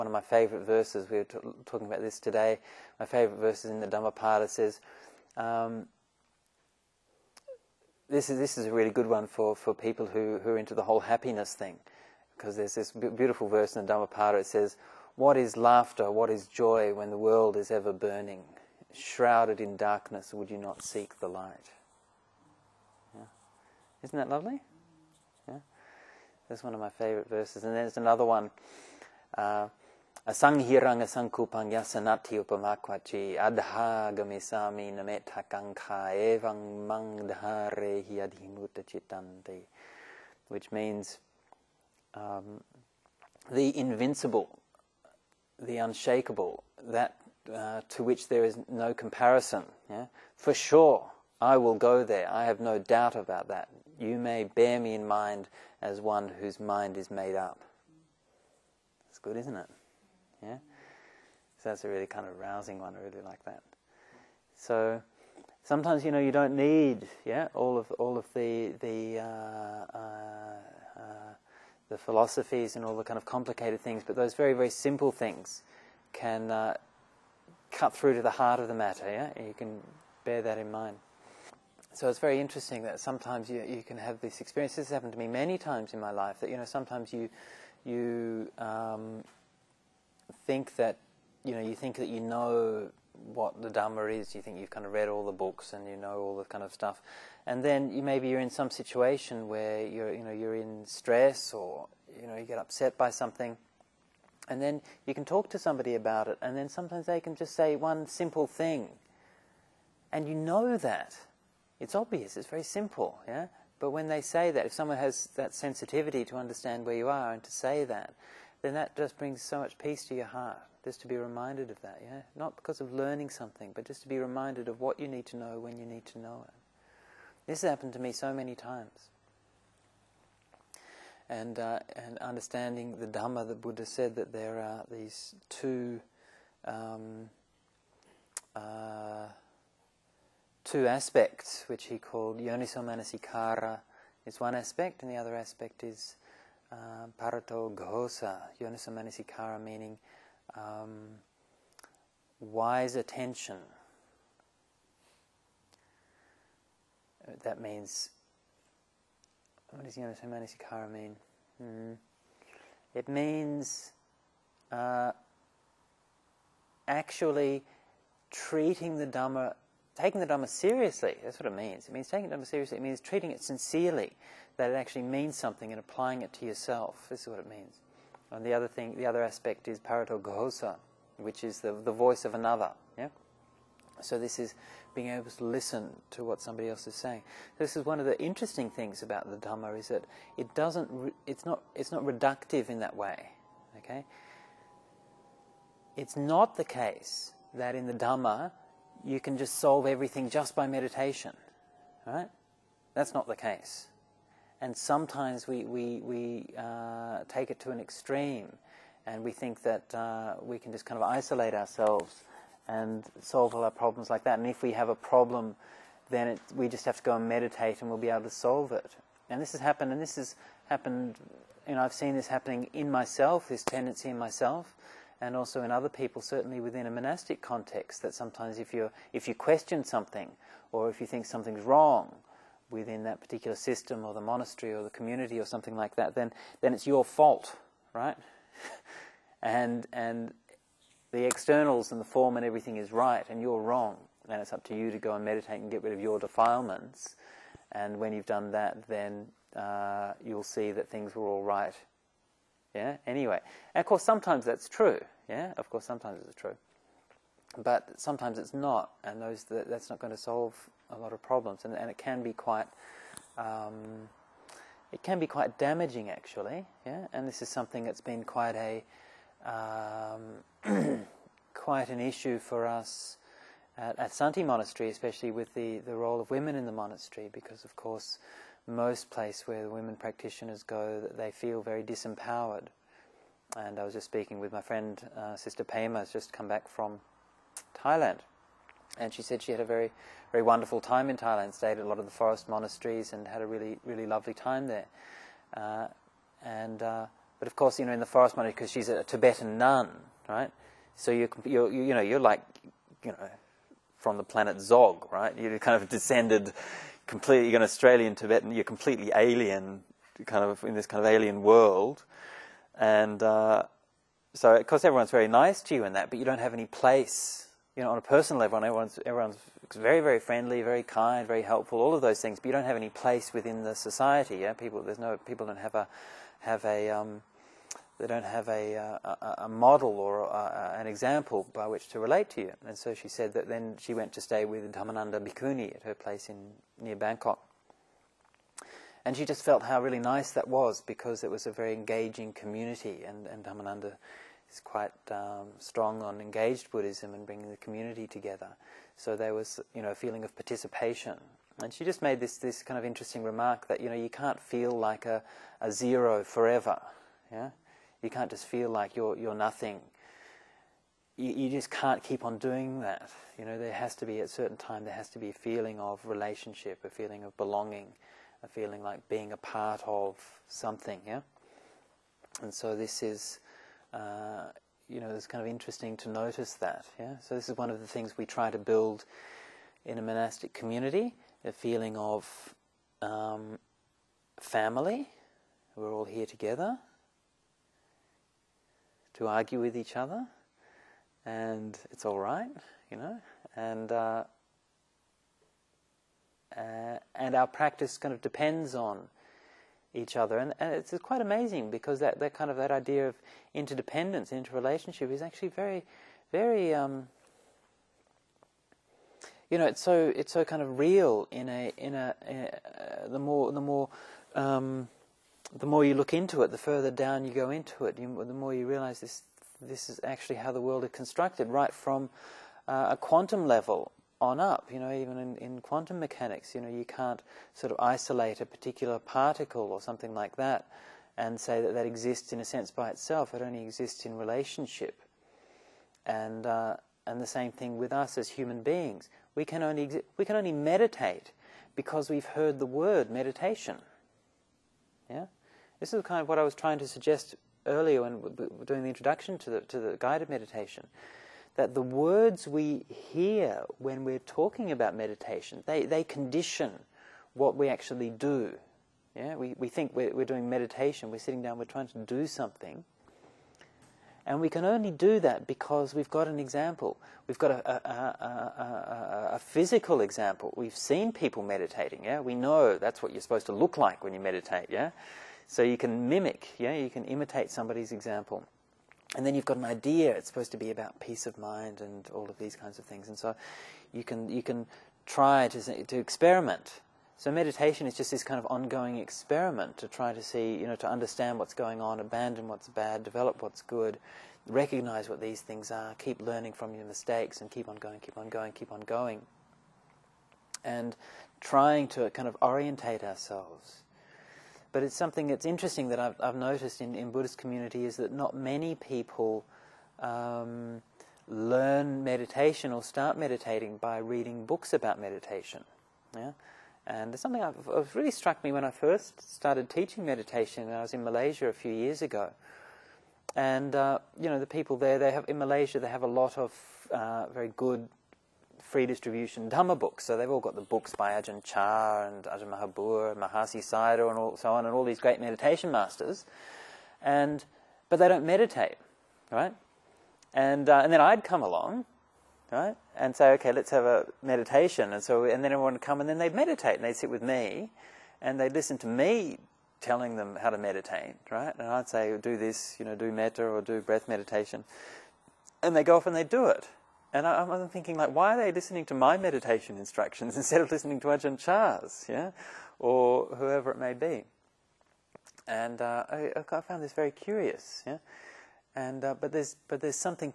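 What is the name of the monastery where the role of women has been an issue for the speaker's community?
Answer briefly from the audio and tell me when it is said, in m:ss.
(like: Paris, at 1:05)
Santi Monastery, at 4:34.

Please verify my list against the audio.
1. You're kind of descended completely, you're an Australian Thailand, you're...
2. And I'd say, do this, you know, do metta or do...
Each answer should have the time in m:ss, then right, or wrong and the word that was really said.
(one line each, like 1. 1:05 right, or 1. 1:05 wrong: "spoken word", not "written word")
1. 5:05 wrong: "Tibetan", not "Thailand"
2. 9:11 right.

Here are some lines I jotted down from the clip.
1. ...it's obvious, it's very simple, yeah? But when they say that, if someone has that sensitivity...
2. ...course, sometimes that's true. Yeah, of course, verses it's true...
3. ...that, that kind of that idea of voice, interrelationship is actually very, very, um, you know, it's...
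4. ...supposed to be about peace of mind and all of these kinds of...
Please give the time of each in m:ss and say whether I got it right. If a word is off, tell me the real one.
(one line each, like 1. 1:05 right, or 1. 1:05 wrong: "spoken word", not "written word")
1. 1:51 right
2. 4:13 wrong: "sometimes", not "verses"
3. 6:41 wrong: "interdependence", not "voice"
4. 8:00 right.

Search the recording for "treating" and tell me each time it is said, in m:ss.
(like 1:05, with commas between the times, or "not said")
2:48, 2:53.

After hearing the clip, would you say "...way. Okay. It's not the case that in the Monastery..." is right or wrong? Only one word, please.
wrong.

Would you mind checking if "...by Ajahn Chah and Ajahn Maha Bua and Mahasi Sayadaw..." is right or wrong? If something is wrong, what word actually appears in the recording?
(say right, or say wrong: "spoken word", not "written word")
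right.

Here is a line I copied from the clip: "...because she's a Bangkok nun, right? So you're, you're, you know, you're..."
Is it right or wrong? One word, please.
wrong.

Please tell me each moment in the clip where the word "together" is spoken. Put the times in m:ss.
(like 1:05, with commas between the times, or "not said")
5:48, 6:26.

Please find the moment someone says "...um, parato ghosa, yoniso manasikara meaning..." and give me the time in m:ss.
2:26.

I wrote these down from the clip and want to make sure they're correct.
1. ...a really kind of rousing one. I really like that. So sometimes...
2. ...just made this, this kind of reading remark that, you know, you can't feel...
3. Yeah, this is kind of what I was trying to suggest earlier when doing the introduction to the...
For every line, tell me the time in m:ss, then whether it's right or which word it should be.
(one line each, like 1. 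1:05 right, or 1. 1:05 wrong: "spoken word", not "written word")
1. 1:01 right
2. 5:51 wrong: "interesting", not "reading"
3. 7:25 right.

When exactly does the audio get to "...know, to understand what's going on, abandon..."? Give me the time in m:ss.
8:10.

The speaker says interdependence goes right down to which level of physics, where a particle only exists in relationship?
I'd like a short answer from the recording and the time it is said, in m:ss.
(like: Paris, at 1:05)
quantum level, at 7:02.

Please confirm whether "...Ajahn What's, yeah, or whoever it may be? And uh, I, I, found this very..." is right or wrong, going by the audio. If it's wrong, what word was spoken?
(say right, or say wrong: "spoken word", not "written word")
wrong: "Chah", not "What".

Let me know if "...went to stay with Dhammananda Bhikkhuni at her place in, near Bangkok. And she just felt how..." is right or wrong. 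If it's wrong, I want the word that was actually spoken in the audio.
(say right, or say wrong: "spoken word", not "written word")
right.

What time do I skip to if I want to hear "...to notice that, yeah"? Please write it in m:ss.
6:15.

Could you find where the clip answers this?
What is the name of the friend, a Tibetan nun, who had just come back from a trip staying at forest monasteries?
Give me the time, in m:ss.
4:45.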